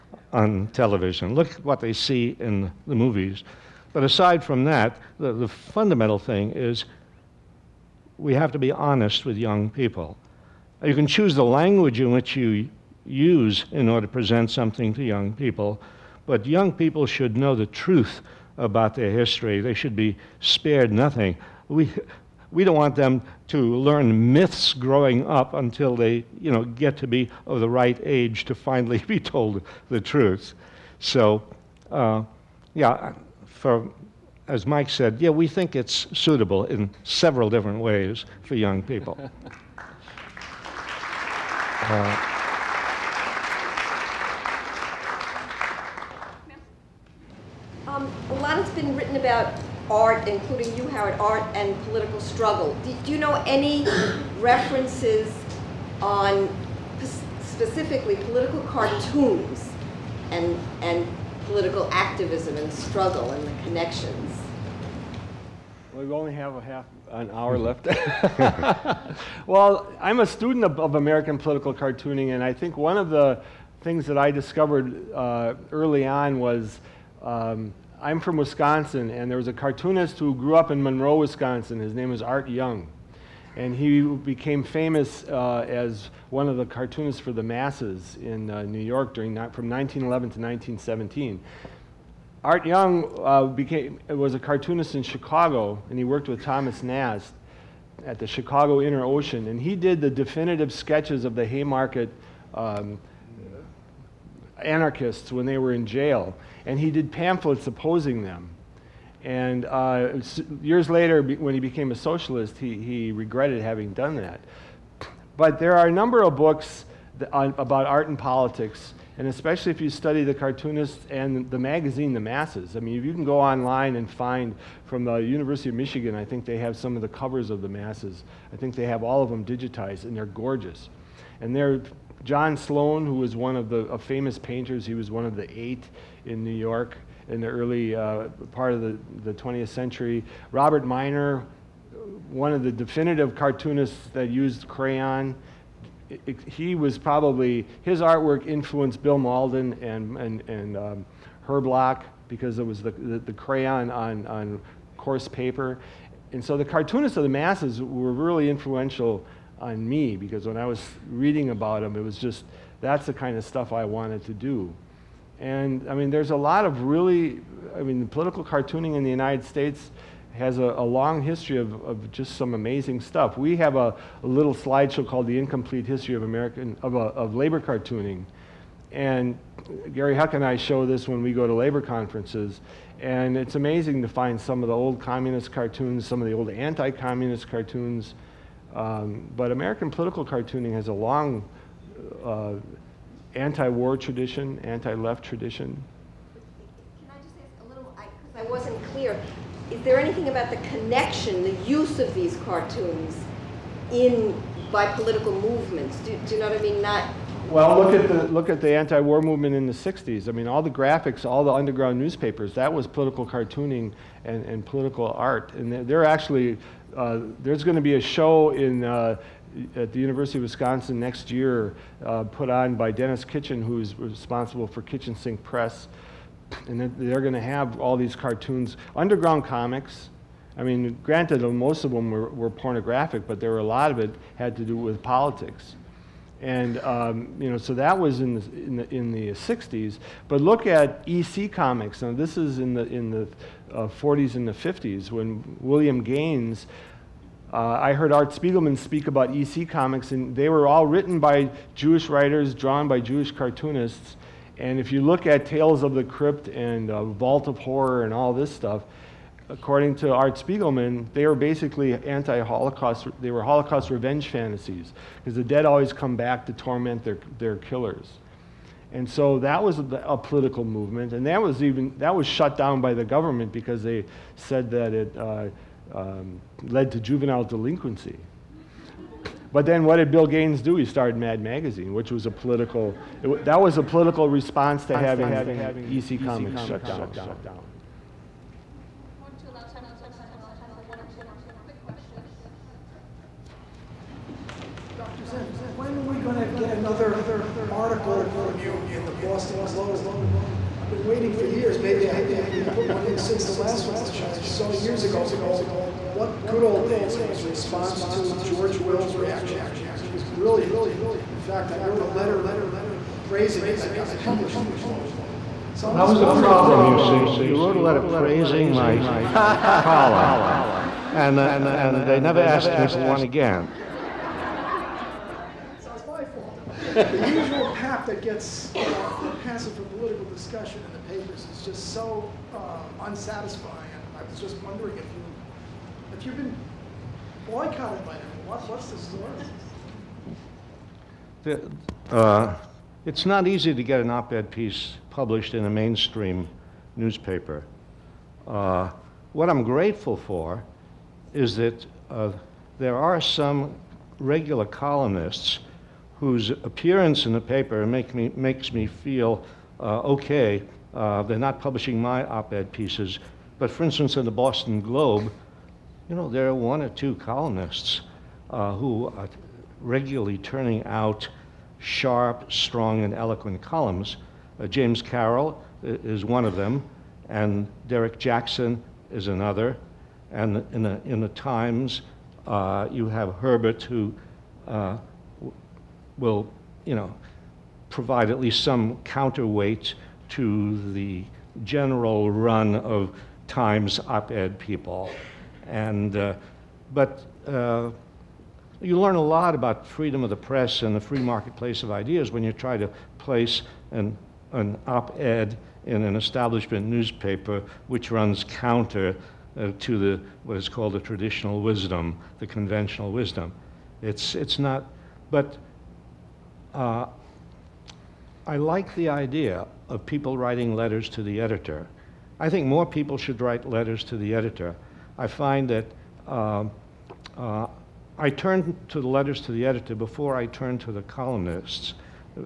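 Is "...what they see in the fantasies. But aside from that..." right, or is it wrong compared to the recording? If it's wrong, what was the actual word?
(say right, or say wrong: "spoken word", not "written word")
wrong: "movies", not "fantasies".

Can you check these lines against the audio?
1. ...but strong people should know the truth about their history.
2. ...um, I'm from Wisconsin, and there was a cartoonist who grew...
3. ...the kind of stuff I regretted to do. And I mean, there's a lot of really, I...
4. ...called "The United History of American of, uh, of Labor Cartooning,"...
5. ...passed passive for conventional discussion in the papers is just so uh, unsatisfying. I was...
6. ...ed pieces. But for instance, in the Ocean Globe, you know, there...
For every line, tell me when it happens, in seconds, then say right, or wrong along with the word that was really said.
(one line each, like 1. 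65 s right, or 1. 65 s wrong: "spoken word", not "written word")
1. 16 s wrong: "young", not "strong"
2. 77 s right
3. 163 s wrong: "wanted", not "regretted"
4. 175 s wrong: "Incomplete", not "United"
5. 328 s wrong: "political", not "conventional"
6. 362 s wrong: "Boston", not "Ocean".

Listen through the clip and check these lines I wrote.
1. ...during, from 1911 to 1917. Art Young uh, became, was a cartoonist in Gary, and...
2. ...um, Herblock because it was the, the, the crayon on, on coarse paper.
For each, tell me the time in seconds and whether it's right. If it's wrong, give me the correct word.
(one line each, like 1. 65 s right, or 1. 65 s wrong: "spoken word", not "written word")
1. 89 s wrong: "Chicago", not "Gary"
2. 150 s right.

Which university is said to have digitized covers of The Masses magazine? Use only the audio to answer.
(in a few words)
University of Michigan.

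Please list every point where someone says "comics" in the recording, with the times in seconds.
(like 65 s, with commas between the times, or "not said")
229 s, 241 s, 249 s, 286 s.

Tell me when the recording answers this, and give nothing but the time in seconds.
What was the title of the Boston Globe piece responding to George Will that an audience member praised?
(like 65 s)
306 s.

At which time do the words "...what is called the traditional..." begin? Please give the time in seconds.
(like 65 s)
410 s.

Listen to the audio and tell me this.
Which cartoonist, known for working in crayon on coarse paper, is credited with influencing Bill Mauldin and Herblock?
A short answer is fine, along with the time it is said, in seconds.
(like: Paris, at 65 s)
Robert Minor, at 140 s.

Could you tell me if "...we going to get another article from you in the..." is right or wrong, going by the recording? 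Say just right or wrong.
right.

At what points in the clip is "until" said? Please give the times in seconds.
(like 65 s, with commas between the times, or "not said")
25 s.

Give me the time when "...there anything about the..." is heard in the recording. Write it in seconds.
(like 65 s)
199 s.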